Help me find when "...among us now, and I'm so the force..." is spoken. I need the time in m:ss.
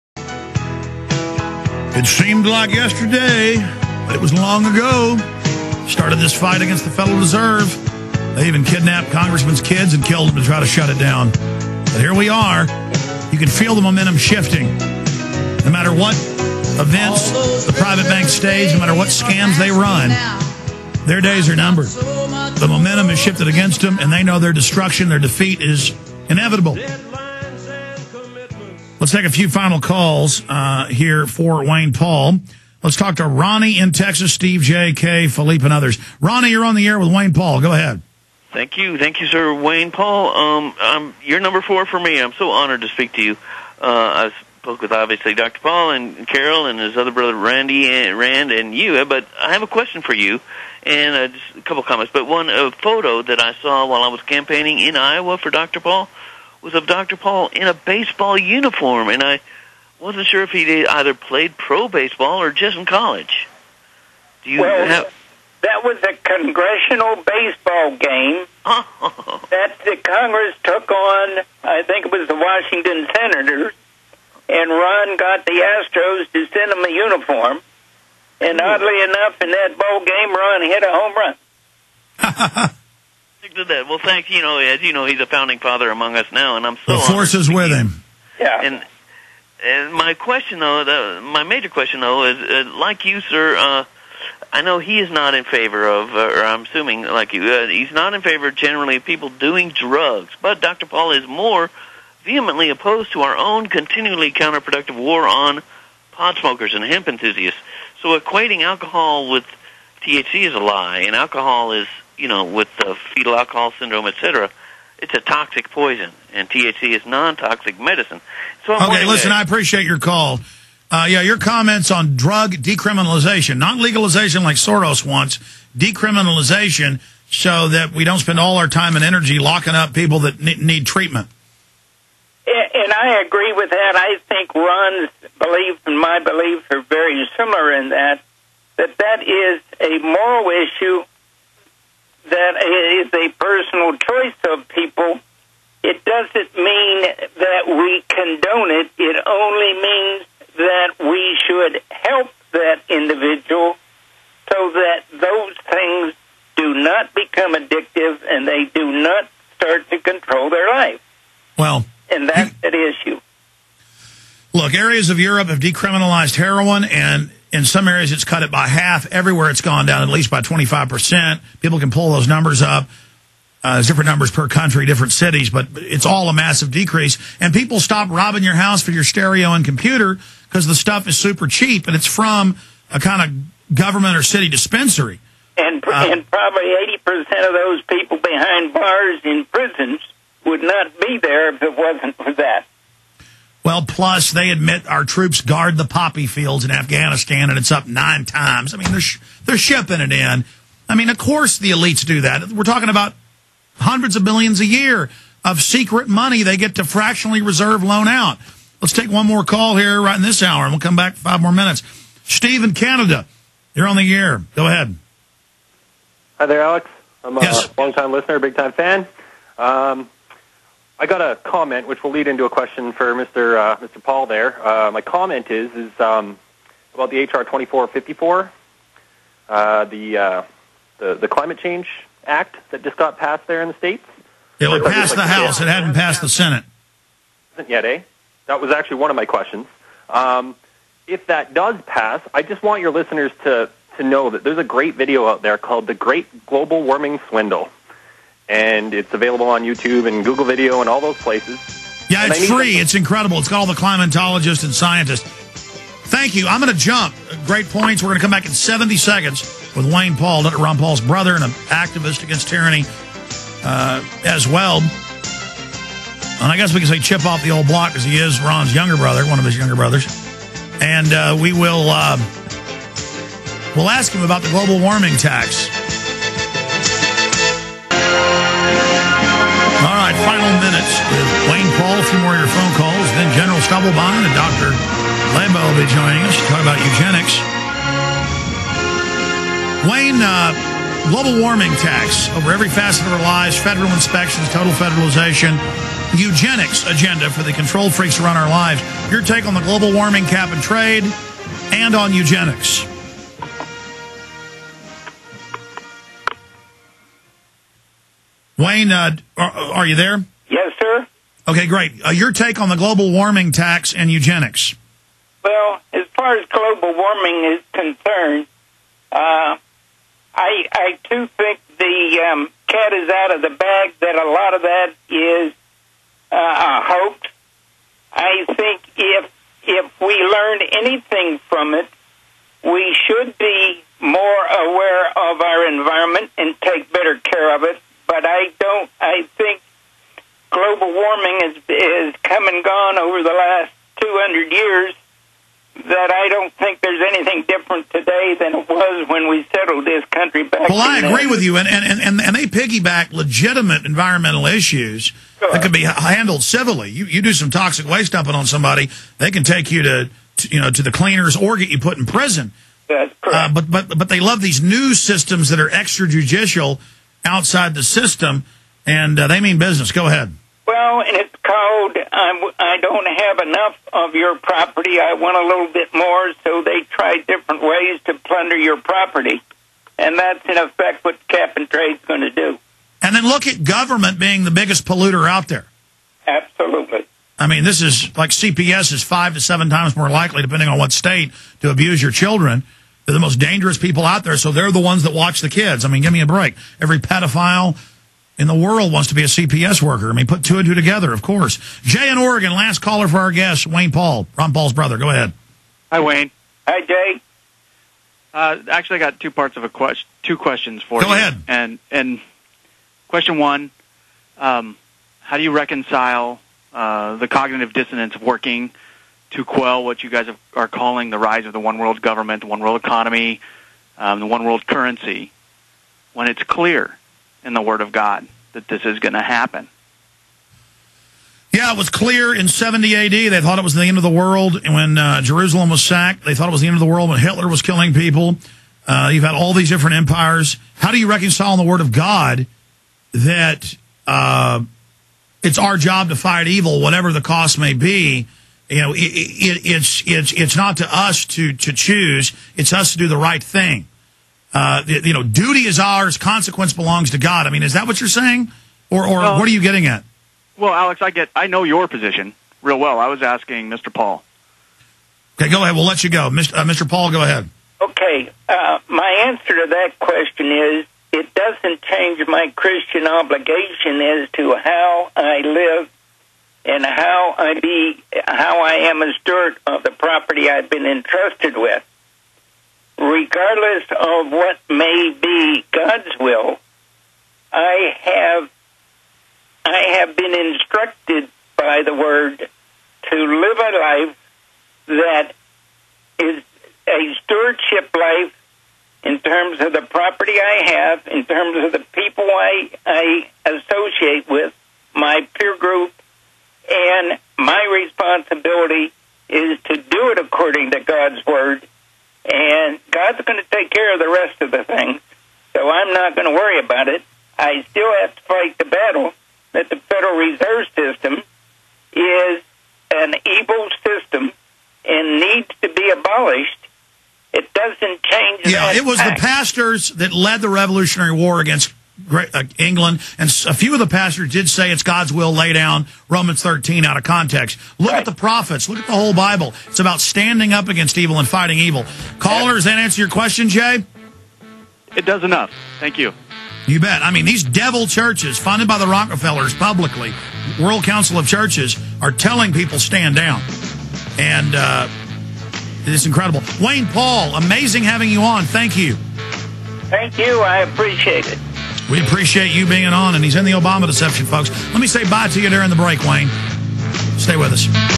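1:25.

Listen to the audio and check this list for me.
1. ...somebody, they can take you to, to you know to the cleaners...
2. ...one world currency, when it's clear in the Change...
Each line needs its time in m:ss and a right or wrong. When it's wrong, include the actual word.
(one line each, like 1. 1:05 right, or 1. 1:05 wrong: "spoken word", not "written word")
1. 5:58 right
2. 7:04 wrong: "Word", not "Change".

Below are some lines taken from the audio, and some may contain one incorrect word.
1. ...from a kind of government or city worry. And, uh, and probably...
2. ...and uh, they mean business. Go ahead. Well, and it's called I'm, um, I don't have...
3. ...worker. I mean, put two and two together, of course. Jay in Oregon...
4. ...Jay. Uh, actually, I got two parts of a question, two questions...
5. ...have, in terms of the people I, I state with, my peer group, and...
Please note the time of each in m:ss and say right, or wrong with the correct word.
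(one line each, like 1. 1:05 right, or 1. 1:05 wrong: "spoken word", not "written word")
1. 3:02 wrong: "dispensary", not "worry"
2. 6:08 right
3. 6:39 right
4. 6:46 right
5. 8:20 wrong: "associate", not "state".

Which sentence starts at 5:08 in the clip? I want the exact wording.
Wayne, uh, are, are, you there?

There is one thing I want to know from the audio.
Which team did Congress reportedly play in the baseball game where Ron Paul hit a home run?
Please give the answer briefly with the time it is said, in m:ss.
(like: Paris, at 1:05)
Washington Senators, at 1:12.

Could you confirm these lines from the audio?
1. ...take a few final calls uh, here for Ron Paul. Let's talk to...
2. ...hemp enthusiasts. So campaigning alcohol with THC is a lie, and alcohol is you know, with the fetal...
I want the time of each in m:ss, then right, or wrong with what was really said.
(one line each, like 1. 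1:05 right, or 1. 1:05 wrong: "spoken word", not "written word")
1. 0:29 wrong: "Wayne", not "Ron"
2. 1:46 wrong: "equating", not "campaigning".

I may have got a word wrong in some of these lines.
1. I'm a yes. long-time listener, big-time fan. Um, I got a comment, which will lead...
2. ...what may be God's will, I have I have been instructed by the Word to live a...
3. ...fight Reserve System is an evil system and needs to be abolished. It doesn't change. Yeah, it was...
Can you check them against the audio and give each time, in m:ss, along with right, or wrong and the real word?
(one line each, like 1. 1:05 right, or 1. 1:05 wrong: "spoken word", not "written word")
1. 3:37 right
2. 8:04 right
3. 8:38 right.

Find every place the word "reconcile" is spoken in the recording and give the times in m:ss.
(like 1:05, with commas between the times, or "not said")
6:55, 7:21.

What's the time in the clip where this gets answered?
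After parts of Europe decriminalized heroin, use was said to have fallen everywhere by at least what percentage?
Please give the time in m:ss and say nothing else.
2:50.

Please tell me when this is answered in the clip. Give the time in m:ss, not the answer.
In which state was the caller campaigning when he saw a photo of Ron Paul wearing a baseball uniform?
0:54.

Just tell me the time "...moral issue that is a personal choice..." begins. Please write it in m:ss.
2:20.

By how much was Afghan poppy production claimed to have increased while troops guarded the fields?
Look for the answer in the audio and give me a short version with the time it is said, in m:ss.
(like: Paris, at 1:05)
9 times, at 3:17.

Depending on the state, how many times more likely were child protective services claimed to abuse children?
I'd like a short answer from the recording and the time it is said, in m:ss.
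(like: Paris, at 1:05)
5 to 7 times, at 6:29.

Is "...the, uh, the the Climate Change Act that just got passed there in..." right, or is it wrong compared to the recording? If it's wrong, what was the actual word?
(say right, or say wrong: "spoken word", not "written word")
right.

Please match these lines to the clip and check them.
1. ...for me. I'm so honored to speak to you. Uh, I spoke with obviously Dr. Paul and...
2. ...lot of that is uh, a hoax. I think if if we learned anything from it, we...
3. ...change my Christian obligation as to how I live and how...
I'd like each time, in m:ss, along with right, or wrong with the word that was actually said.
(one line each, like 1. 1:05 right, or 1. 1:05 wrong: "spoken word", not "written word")
1. 0:41 right
2. 5:24 right
3. 7:51 right.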